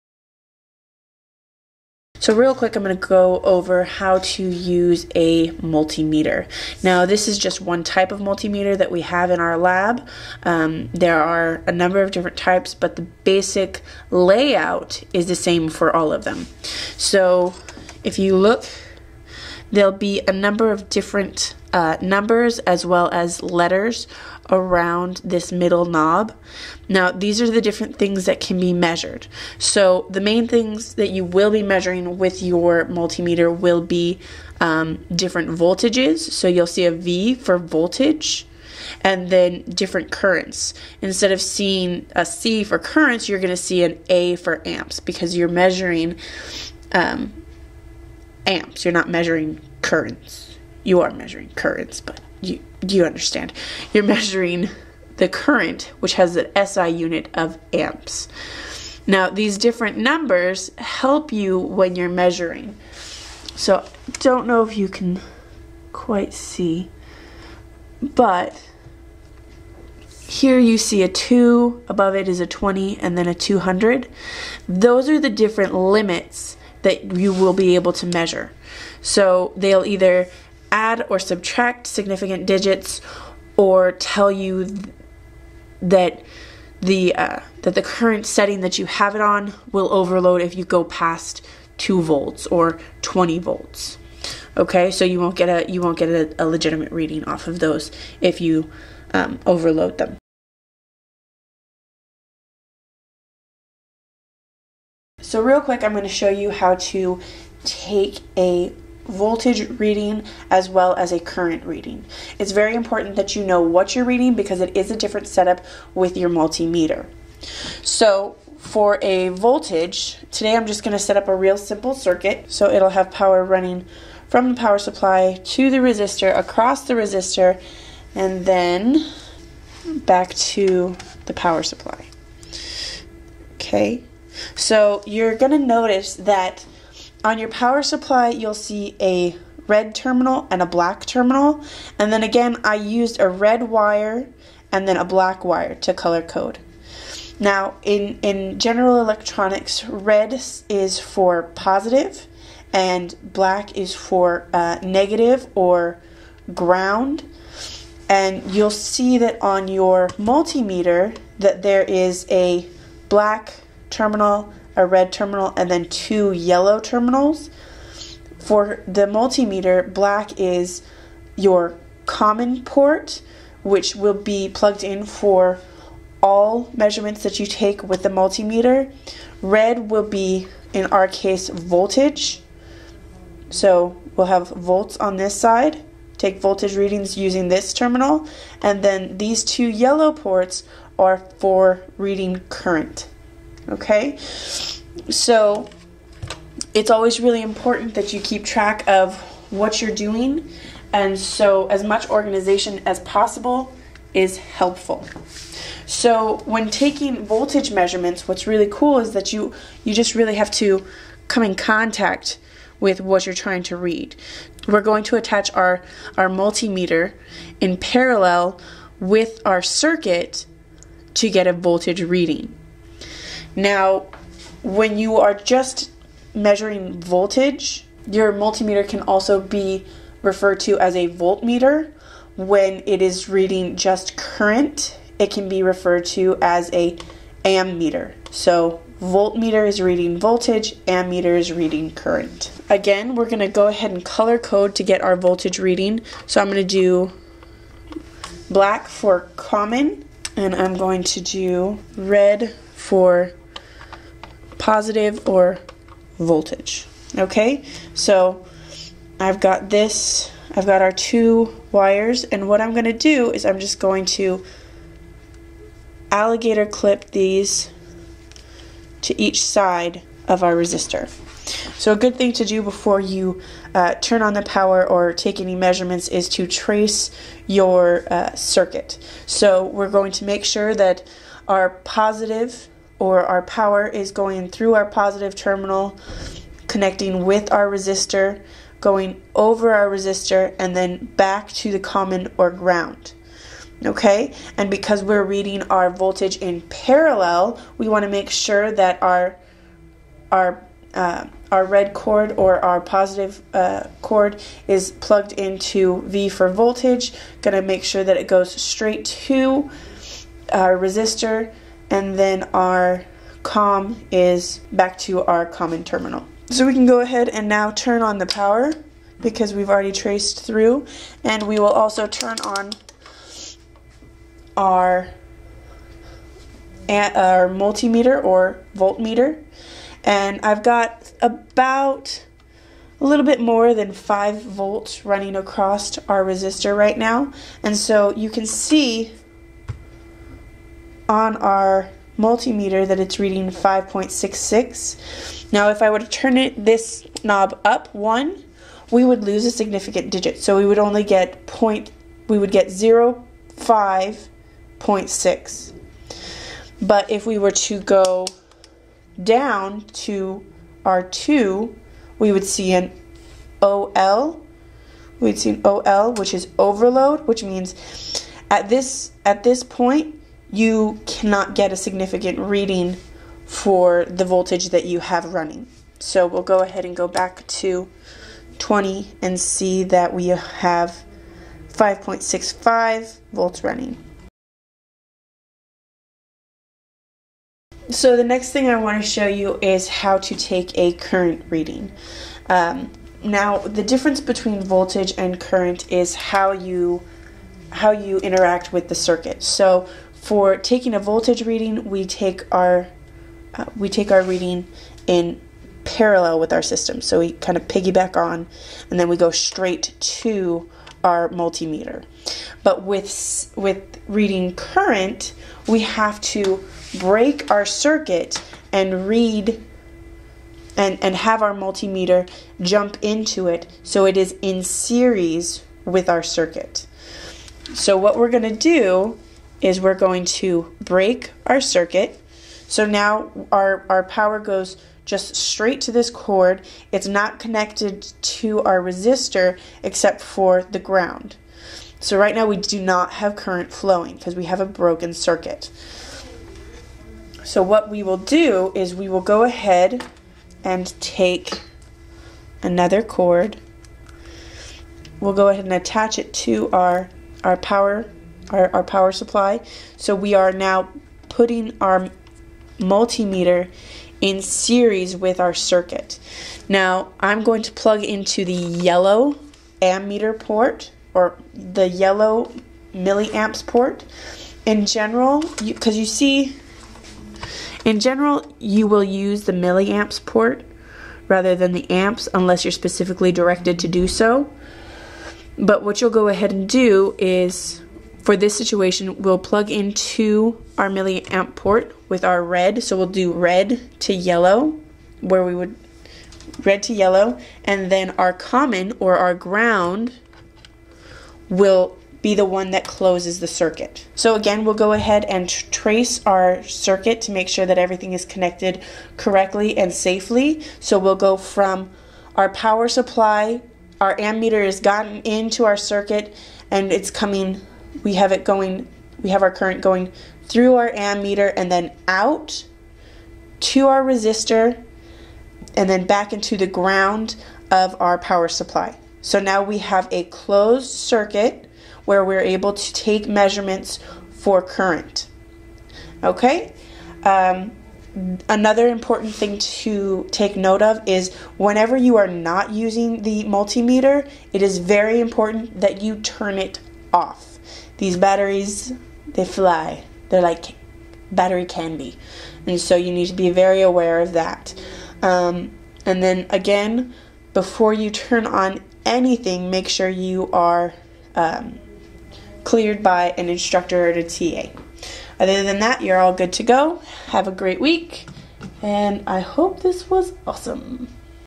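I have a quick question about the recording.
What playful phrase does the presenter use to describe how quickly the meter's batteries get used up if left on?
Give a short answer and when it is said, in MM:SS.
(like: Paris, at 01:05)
Battery candy, at 09:11.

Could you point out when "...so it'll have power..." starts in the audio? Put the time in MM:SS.
02:02.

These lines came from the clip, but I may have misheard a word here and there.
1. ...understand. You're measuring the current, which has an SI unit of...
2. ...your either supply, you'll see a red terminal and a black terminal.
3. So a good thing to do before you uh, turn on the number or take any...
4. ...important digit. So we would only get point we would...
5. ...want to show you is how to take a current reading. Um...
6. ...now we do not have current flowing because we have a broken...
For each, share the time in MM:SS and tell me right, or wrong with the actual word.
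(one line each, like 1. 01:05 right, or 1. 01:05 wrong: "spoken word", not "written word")
1. 00:53 right
2. 02:17 wrong: "power", not "either"
3. 04:31 wrong: "power", not "number"
4. 05:49 wrong: "significant", not "important"
5. 06:28 right
6. 07:22 right.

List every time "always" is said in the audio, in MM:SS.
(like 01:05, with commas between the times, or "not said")
03:16.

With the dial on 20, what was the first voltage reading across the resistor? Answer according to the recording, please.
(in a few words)
5.66.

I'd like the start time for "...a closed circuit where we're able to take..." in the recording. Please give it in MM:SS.
08:50.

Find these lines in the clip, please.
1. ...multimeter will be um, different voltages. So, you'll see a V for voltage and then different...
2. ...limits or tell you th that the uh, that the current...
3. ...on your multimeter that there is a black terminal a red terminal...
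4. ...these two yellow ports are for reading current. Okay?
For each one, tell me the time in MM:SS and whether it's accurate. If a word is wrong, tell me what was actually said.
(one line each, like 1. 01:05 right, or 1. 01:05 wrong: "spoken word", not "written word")
1. 00:32 right
2. 01:22 wrong: "digits", not "limits"
3. 02:39 right
4. 03:09 right.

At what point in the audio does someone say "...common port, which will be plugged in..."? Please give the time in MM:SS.
02:52.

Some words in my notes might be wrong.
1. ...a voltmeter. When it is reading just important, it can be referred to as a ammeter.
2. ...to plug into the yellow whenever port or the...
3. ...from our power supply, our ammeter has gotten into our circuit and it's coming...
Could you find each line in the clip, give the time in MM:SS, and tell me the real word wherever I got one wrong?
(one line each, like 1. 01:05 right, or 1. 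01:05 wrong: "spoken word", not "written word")
1. 03:50 wrong: "current", not "important"
2. 07:47 wrong: "ammeter", not "whenever"
3. 08:31 right.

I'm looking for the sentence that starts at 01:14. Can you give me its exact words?
Those are the different limits that you will be able to measure.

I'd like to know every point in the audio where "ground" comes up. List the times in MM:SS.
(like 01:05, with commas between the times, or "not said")
02:36, 04:52, 07:20, 08:19, 08:46.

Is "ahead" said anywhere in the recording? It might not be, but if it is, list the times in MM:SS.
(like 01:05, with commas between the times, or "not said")
04:03, 05:17, 06:16, 07:29, 07:35, 08:06, 08:24.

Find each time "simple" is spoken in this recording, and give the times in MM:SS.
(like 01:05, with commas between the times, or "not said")
02:01.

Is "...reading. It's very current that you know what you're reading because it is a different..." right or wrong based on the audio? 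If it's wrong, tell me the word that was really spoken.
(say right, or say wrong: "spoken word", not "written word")
wrong: "important", not "current".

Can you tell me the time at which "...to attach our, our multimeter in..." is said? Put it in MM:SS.
03:35.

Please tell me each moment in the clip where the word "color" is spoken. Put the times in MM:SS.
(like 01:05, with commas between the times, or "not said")
02:25, 04:04.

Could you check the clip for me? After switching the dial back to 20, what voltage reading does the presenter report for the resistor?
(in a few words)
5.65 volts.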